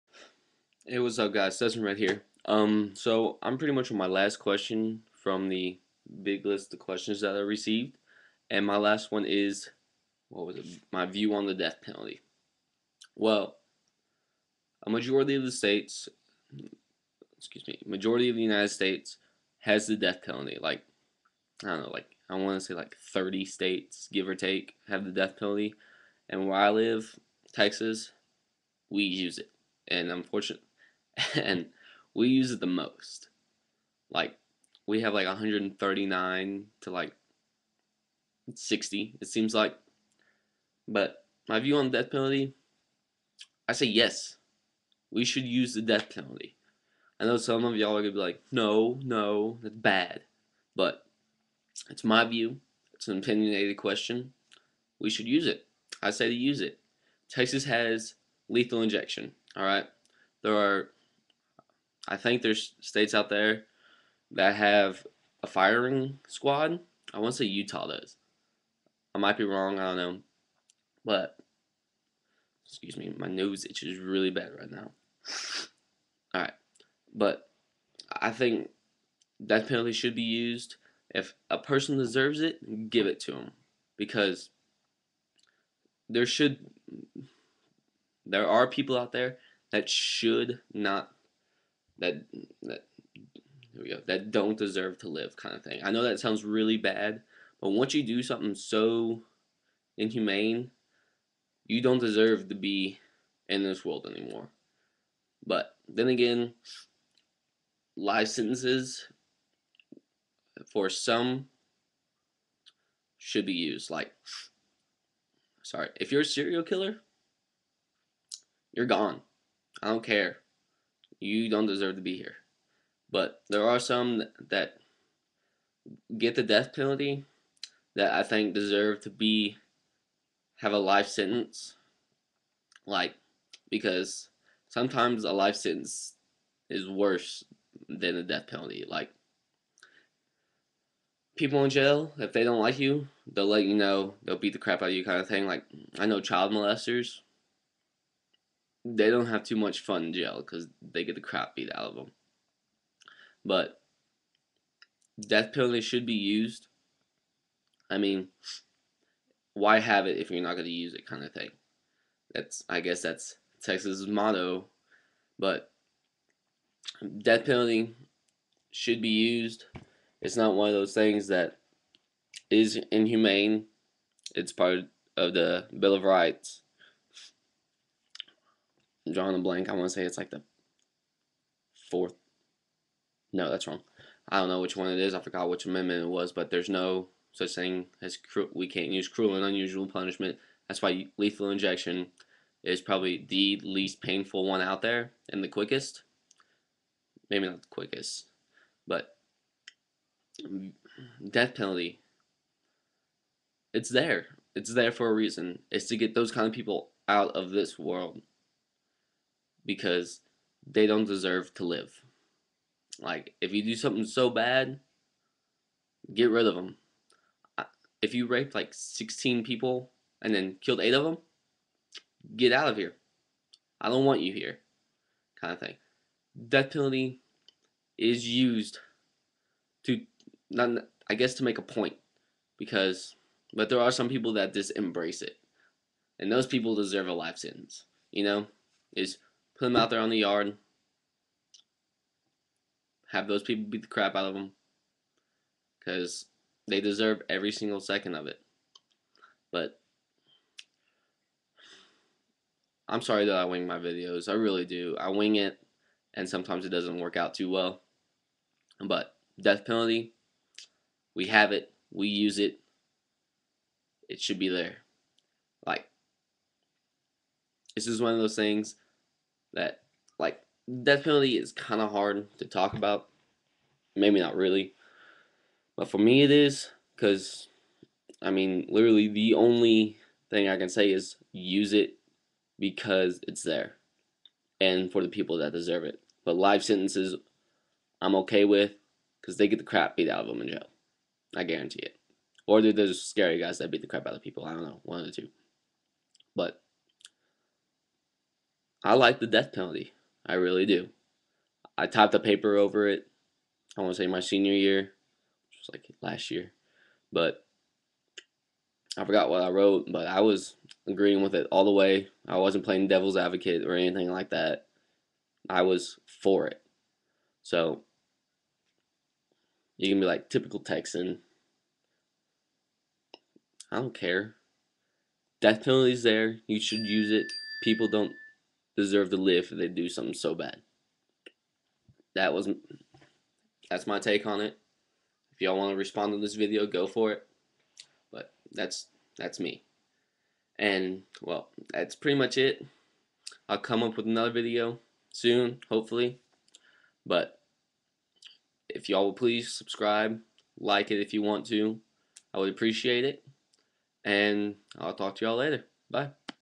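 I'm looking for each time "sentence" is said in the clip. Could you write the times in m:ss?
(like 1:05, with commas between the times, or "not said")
2:11, 2:15, 3:57, 4:46.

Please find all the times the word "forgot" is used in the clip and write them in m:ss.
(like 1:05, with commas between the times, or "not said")
3:05, 5:09.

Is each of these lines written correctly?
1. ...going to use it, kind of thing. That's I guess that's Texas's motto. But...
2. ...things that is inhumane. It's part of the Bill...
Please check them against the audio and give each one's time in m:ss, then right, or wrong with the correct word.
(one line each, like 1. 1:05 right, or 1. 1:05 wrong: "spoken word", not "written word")
1. 2:40 right
2. 2:50 right.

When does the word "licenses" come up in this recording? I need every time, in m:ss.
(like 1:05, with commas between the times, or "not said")
1:47.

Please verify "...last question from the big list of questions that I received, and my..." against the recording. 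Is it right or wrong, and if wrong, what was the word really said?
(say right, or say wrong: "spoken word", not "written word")
right.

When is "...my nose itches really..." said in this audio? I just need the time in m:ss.
1:13.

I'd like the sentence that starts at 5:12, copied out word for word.
I wasn't playing devil's advocate or anything like that.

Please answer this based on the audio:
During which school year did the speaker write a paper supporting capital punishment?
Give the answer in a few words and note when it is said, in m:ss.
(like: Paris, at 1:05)
senior year, at 5:04.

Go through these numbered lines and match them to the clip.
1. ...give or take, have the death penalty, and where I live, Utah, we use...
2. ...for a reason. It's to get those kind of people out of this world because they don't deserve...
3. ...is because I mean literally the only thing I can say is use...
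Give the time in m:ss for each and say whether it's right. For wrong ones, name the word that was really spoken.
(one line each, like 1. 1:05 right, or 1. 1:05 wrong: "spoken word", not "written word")
1. 0:24 wrong: "Texas", not "Utah"
2. 3:24 right
3. 4:36 right.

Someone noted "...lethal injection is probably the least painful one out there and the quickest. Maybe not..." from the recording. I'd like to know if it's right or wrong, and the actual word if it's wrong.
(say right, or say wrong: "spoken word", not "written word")
right.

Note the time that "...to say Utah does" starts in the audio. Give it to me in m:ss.
1:07.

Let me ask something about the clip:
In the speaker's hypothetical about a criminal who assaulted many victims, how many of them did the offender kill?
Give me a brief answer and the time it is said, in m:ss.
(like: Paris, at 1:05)
8, at 3:40.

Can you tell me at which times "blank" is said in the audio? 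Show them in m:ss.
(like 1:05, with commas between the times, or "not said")
2:59.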